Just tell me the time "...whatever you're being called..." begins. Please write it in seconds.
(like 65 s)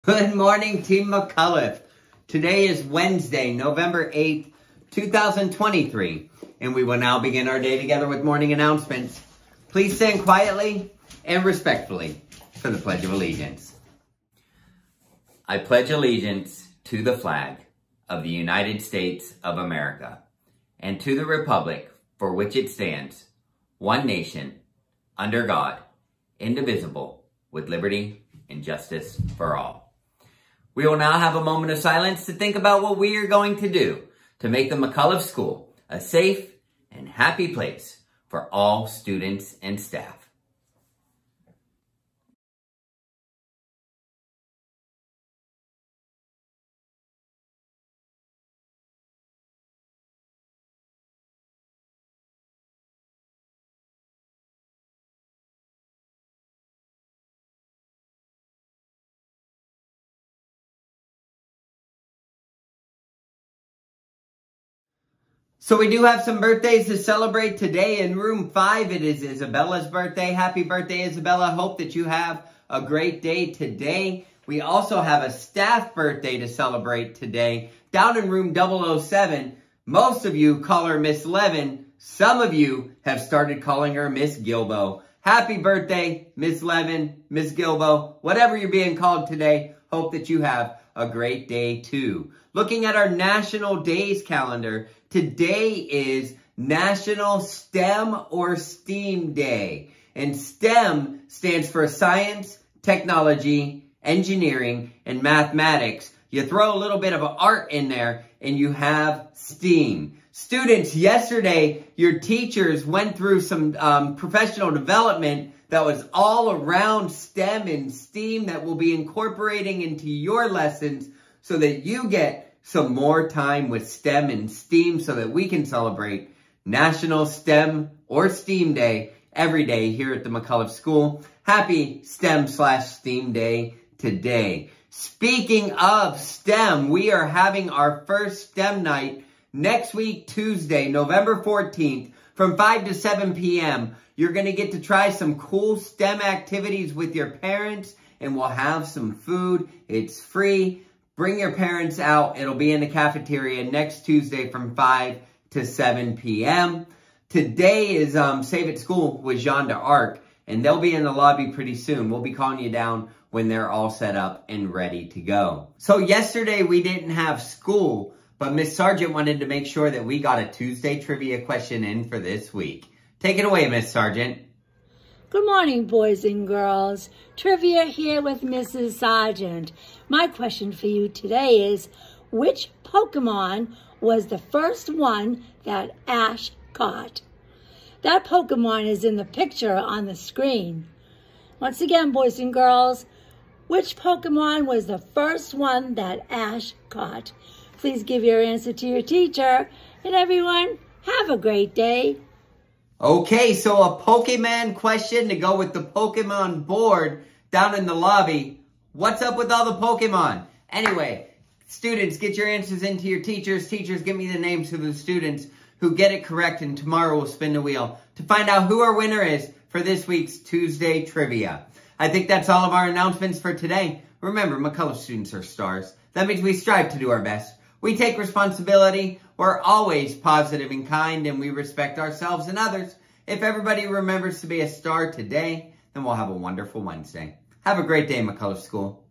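88 s.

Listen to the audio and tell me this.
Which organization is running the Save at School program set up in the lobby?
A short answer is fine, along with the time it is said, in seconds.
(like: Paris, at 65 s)
Jeanne D'Arc, at 159 s.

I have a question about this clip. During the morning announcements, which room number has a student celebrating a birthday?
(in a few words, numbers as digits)
5.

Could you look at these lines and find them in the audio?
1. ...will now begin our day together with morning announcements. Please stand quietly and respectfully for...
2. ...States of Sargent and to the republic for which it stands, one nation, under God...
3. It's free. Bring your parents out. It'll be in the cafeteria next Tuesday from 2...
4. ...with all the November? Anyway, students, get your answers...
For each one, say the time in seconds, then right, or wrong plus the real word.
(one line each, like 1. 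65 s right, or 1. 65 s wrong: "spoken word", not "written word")
1. 6 s right
2. 18 s wrong: "America", not "Sargent"
3. 149 s wrong: "5", not "2"
4. 209 s wrong: "Pokemon", not "November".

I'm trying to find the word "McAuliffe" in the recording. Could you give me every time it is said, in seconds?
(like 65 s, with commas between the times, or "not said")
1 s, 34 s, 130 s, 224 s, 238 s.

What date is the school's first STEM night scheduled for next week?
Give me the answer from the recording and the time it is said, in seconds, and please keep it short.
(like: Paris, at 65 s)
Tuesday, November 14th, at 140 s.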